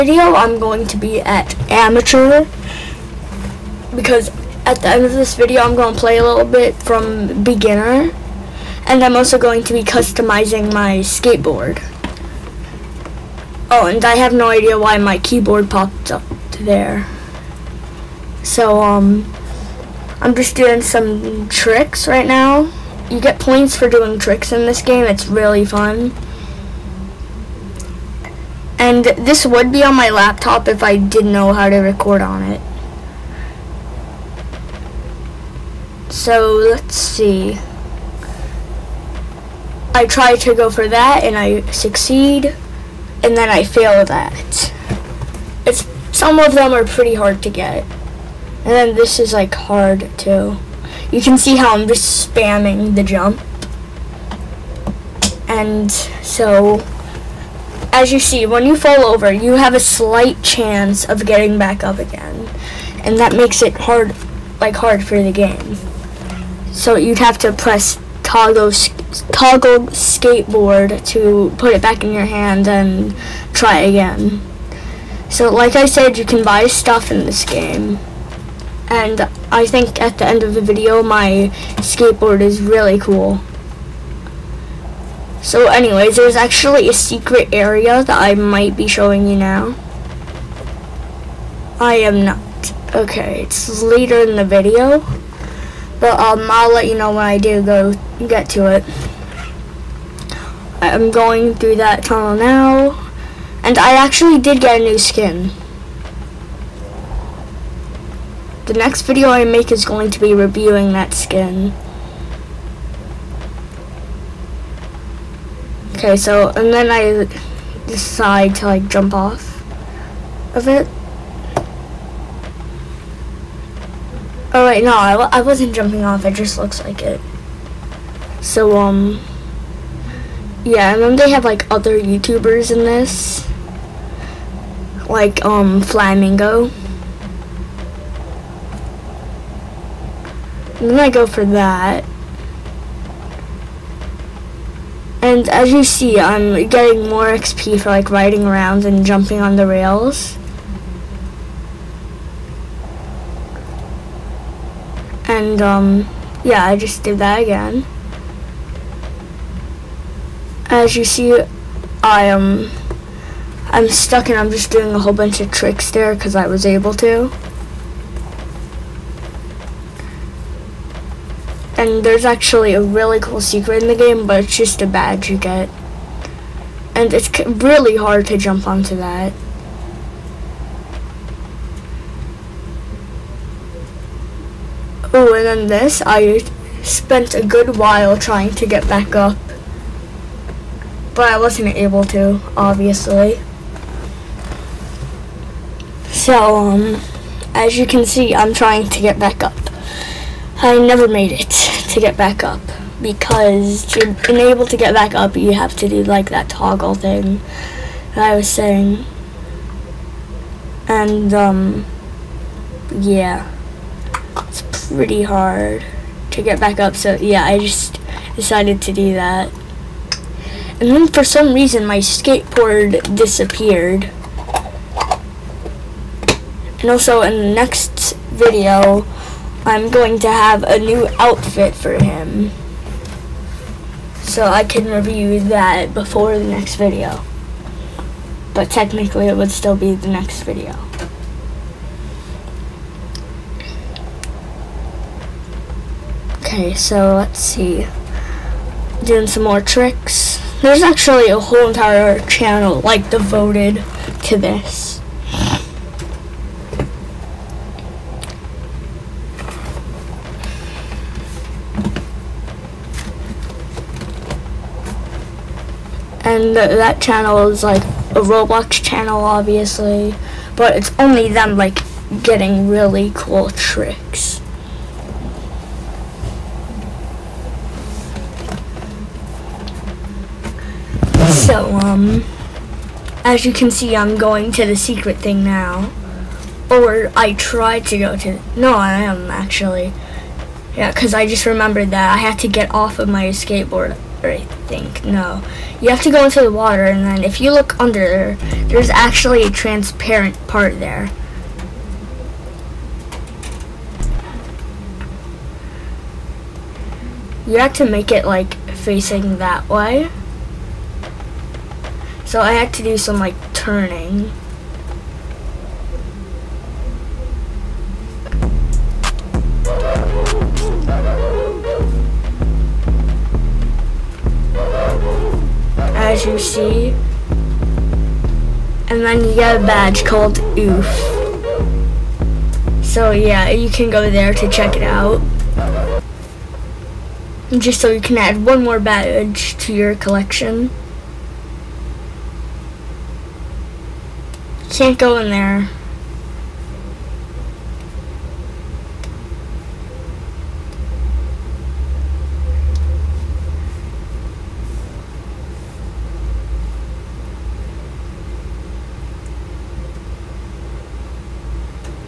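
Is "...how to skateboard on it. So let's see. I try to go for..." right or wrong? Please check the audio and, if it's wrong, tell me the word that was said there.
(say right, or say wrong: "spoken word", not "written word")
wrong: "record", not "skateboard".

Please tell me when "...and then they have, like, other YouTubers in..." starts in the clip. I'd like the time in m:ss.
2:10.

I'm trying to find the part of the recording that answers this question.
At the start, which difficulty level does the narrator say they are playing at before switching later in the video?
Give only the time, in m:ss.
0:01.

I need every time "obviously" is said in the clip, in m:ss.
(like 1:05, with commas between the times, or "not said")
3:12, 4:29.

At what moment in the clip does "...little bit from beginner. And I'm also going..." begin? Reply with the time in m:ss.
0:06.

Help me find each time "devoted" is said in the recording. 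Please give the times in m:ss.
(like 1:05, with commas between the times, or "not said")
4:13.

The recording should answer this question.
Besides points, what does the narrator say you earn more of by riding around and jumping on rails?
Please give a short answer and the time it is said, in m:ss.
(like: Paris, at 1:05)
XP, at 2:27.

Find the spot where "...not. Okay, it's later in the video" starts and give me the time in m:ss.
1:32.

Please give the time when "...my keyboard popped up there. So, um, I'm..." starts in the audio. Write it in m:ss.
0:14.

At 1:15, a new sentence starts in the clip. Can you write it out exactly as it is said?
So like I said, you can buy stuff in this game.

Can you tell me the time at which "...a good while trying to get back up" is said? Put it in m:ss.
3:07.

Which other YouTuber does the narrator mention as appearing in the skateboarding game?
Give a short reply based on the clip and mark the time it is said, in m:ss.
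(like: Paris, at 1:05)
Flamingo, at 2:15.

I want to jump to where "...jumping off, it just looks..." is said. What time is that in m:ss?
2:05.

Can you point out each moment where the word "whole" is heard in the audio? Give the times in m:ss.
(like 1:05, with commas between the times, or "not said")
2:44, 4:11.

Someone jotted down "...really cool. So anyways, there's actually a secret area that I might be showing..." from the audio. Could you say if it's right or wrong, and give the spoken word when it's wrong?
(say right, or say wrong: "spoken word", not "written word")
right.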